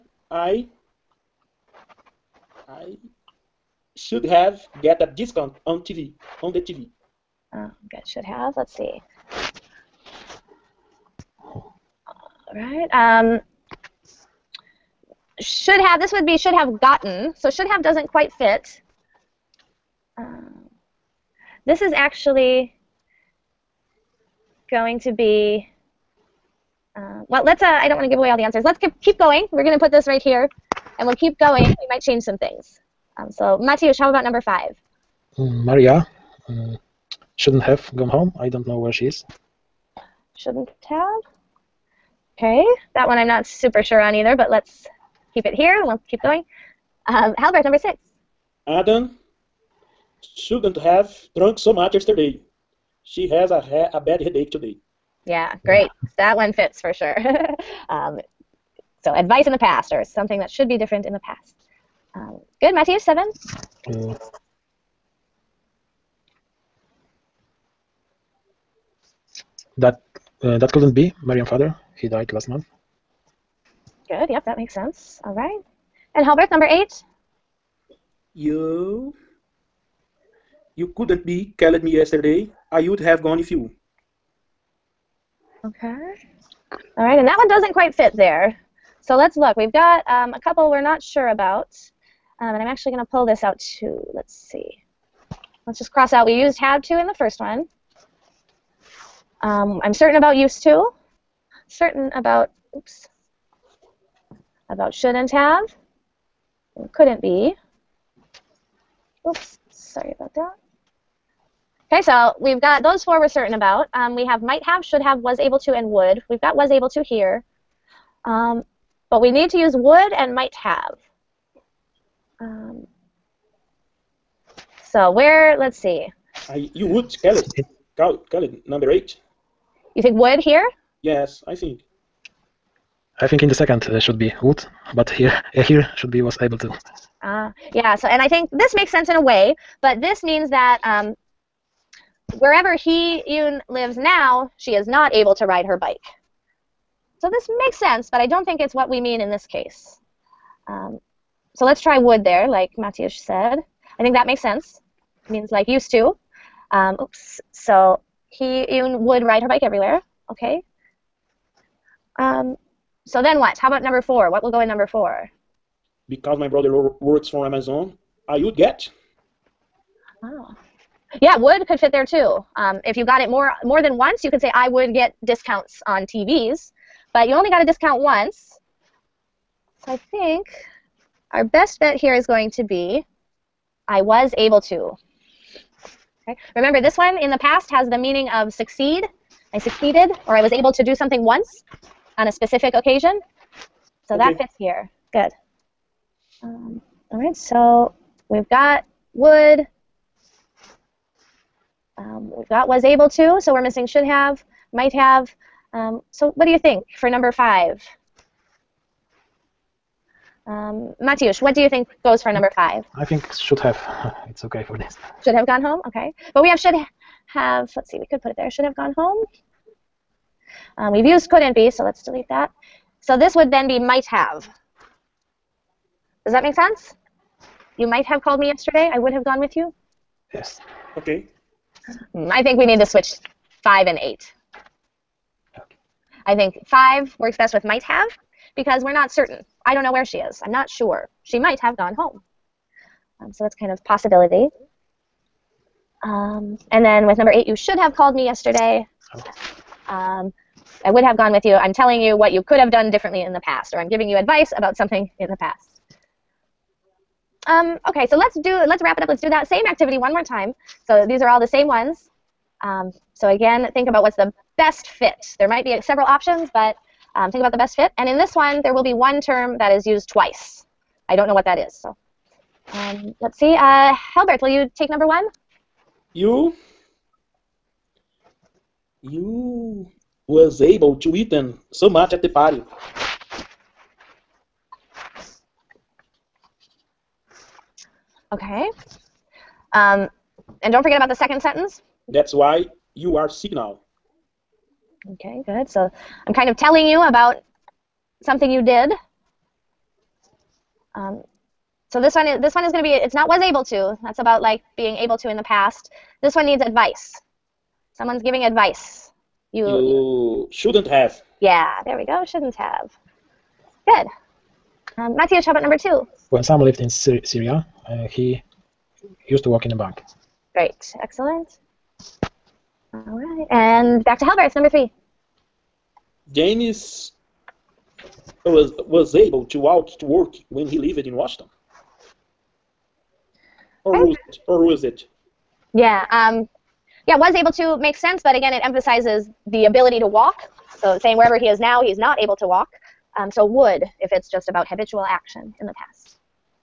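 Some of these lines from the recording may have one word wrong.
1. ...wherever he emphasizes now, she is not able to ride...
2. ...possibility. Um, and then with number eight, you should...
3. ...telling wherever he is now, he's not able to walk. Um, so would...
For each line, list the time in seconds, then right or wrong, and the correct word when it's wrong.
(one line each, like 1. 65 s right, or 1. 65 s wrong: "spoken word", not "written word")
1. 142 s wrong: "lives", not "emphasizes"
2. 243 s right
3. 340 s wrong: "saying", not "telling".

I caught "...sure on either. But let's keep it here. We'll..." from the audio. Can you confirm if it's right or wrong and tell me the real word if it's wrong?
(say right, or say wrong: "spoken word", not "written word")
right.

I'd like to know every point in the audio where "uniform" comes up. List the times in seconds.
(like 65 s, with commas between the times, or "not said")
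not said.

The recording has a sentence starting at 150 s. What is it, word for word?
Um, so let's try would there, like Matthias said.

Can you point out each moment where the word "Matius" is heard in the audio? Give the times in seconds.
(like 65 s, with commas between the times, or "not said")
33 s, 211 s.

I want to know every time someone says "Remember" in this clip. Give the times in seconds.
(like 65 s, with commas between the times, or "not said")
186 s.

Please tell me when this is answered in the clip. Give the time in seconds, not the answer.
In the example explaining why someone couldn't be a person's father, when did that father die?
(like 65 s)
72 s.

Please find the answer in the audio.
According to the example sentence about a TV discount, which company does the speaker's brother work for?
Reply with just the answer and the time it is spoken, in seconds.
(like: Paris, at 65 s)
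Amazon, at 167 s.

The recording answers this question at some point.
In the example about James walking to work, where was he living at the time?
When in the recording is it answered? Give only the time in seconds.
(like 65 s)
331 s.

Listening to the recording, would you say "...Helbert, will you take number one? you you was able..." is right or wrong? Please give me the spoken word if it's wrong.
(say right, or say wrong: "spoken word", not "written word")
right.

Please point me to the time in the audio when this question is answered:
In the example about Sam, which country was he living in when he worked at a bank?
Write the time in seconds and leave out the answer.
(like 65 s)
316 s.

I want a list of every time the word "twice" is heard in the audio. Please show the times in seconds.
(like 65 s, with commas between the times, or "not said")
270 s.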